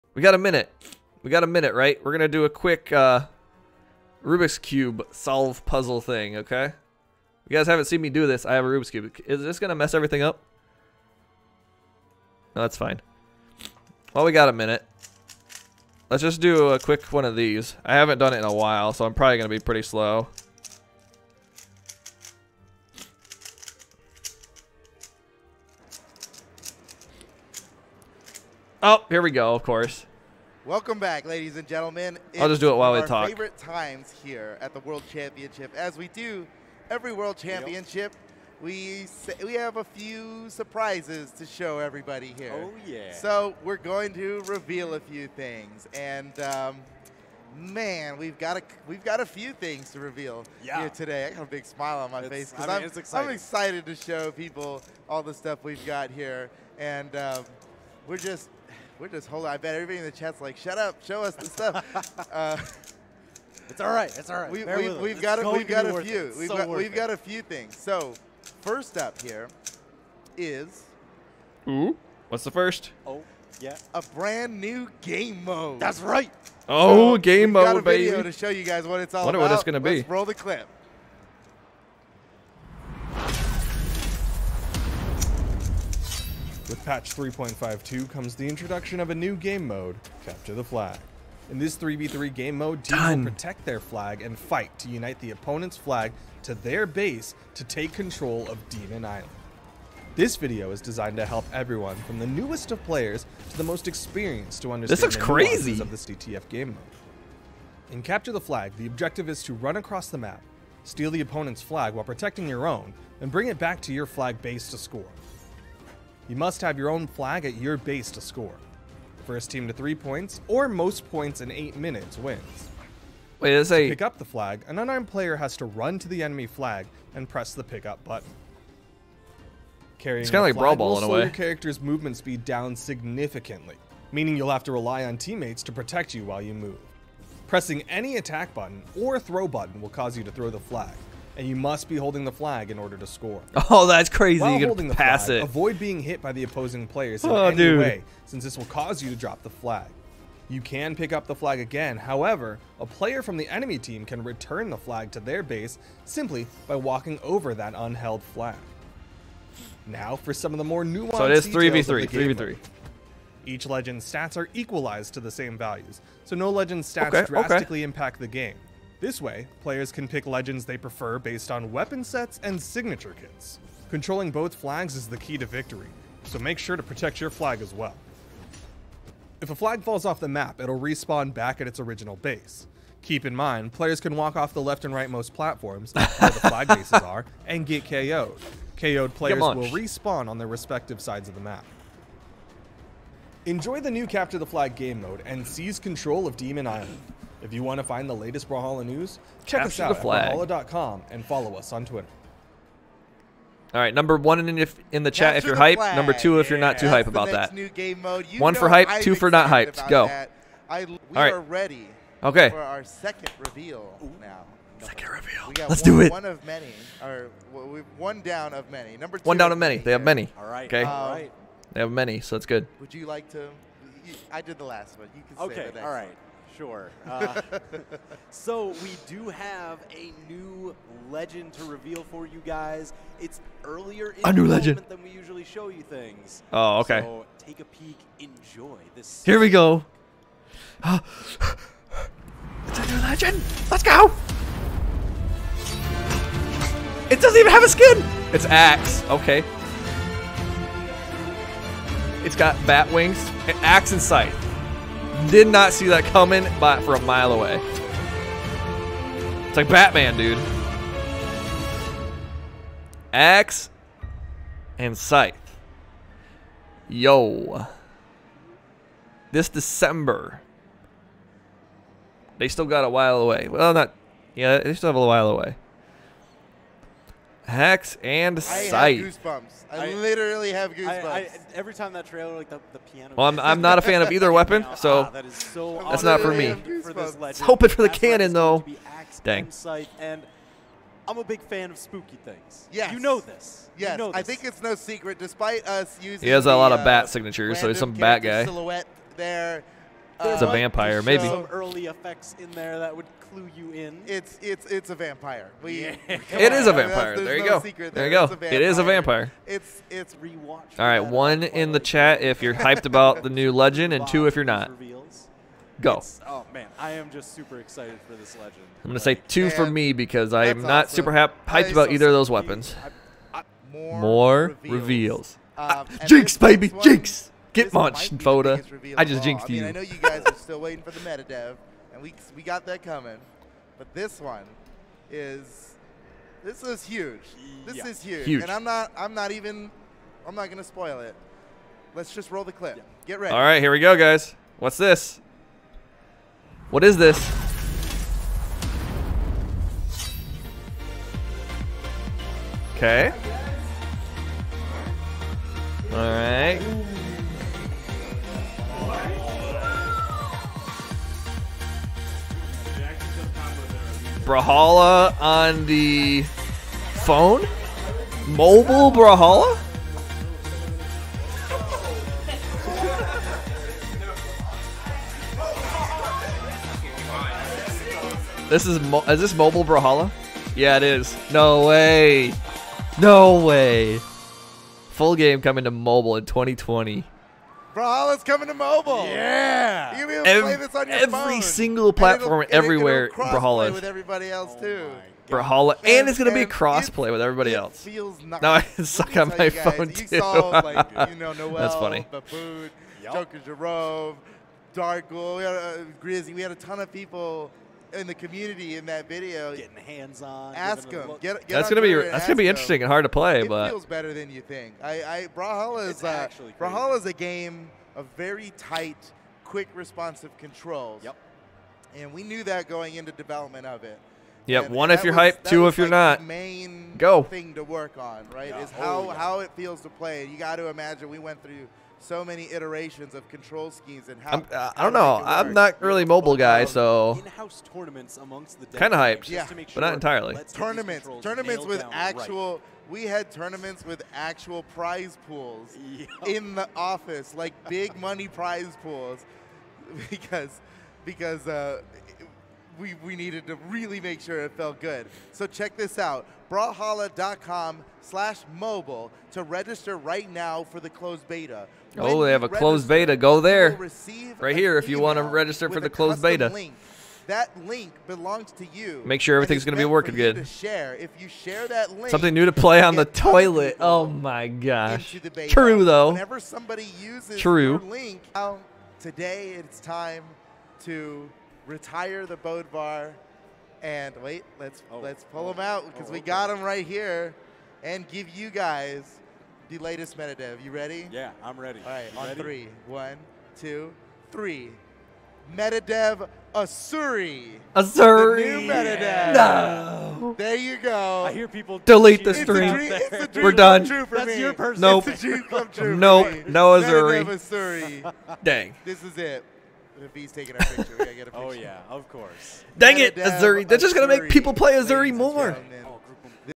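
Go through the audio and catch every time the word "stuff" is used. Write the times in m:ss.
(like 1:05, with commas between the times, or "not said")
0:55, 1:01.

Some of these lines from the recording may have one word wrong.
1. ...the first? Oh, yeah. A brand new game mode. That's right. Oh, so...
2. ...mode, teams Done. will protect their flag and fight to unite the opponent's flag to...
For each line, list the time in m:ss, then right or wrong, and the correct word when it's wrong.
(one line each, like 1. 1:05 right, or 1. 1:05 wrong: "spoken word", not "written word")
1. 1:12 right
2. 1:32 right.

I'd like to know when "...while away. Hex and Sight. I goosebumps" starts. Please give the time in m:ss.
4:35.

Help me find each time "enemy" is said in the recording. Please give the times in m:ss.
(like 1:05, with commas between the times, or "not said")
2:06, 2:33.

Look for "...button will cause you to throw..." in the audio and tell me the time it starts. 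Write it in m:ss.
2:19.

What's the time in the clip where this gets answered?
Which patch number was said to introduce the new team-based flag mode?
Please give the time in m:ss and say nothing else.
1:26.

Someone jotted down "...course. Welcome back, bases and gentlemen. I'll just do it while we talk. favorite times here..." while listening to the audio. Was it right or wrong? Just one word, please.
wrong.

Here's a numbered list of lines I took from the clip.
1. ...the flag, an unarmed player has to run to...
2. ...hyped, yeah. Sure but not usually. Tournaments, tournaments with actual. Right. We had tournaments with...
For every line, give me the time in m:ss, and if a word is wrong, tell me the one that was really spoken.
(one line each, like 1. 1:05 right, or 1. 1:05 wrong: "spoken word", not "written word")
1. 2:04 right
2. 7:18 wrong: "entirely", not "usually".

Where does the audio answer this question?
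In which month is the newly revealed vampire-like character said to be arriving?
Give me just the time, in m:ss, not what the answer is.
4:29.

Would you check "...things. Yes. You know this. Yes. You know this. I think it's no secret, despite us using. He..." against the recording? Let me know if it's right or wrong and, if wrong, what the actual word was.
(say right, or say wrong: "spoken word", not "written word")
right.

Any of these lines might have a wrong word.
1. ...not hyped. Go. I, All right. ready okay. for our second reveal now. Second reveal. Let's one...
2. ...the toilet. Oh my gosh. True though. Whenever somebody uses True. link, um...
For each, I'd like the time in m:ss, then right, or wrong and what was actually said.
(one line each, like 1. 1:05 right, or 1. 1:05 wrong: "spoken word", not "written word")
1. 3:29 right
2. 7:52 right.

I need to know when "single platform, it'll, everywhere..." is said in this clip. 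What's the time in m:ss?
6:31.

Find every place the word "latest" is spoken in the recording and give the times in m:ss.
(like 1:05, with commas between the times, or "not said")
3:18, 8:09.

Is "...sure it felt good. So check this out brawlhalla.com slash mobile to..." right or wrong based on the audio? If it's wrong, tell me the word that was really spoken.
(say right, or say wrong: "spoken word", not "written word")
right.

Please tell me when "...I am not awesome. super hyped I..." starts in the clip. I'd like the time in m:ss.
5:20.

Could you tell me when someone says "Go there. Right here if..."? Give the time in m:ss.
7:43.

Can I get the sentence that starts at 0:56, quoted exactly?
And um, we're just – we're just holding.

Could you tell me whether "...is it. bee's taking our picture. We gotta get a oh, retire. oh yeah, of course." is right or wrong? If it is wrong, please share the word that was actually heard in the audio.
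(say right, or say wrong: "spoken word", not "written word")
wrong: "picture", not "retire".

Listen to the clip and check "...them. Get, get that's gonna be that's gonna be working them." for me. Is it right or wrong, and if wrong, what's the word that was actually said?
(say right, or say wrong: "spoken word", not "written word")
wrong: "interesting", not "working".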